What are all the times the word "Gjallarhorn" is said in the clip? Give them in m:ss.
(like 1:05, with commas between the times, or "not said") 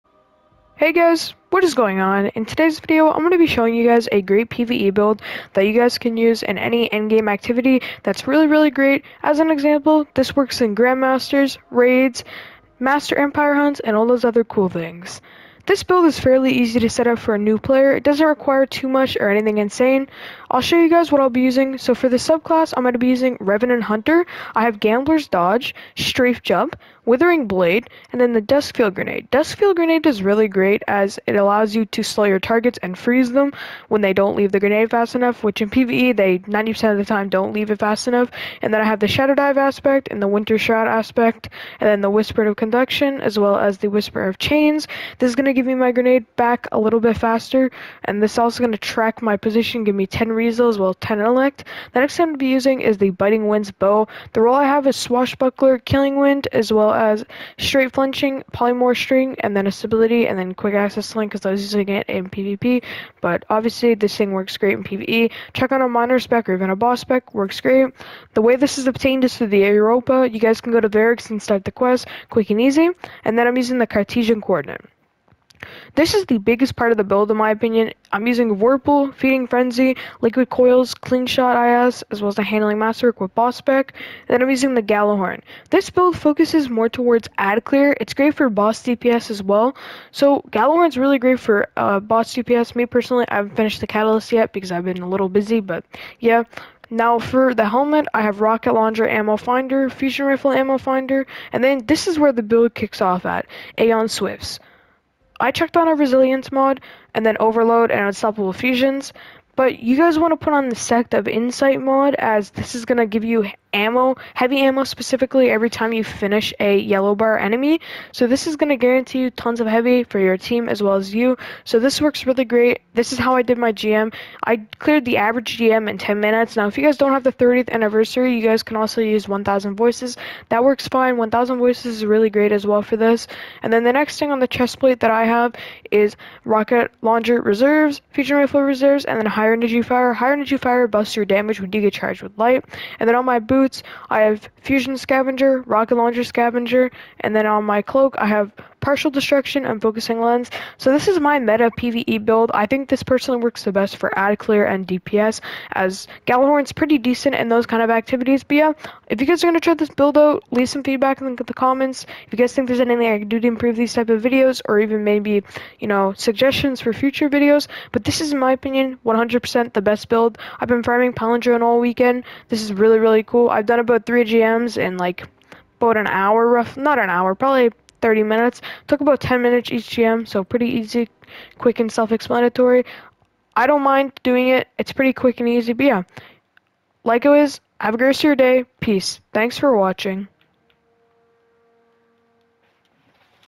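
1:24, 2:36.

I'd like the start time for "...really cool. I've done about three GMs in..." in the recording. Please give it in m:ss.
2:52.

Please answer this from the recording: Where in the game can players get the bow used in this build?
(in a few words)
Europa.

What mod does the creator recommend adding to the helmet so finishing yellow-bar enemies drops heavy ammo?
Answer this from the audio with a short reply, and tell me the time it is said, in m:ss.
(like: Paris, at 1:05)
Sect of Insight, at 1:50.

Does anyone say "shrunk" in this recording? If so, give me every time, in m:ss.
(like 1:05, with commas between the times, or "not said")
not said.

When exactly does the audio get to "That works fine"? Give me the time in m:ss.
2:10.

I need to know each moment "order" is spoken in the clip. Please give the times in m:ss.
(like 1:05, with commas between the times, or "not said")
not said.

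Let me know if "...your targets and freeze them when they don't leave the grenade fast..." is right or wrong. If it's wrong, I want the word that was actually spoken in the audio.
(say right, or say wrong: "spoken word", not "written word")
right.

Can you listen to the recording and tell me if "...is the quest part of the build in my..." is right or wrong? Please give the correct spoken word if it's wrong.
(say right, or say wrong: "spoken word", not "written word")
wrong: "biggest", not "quest".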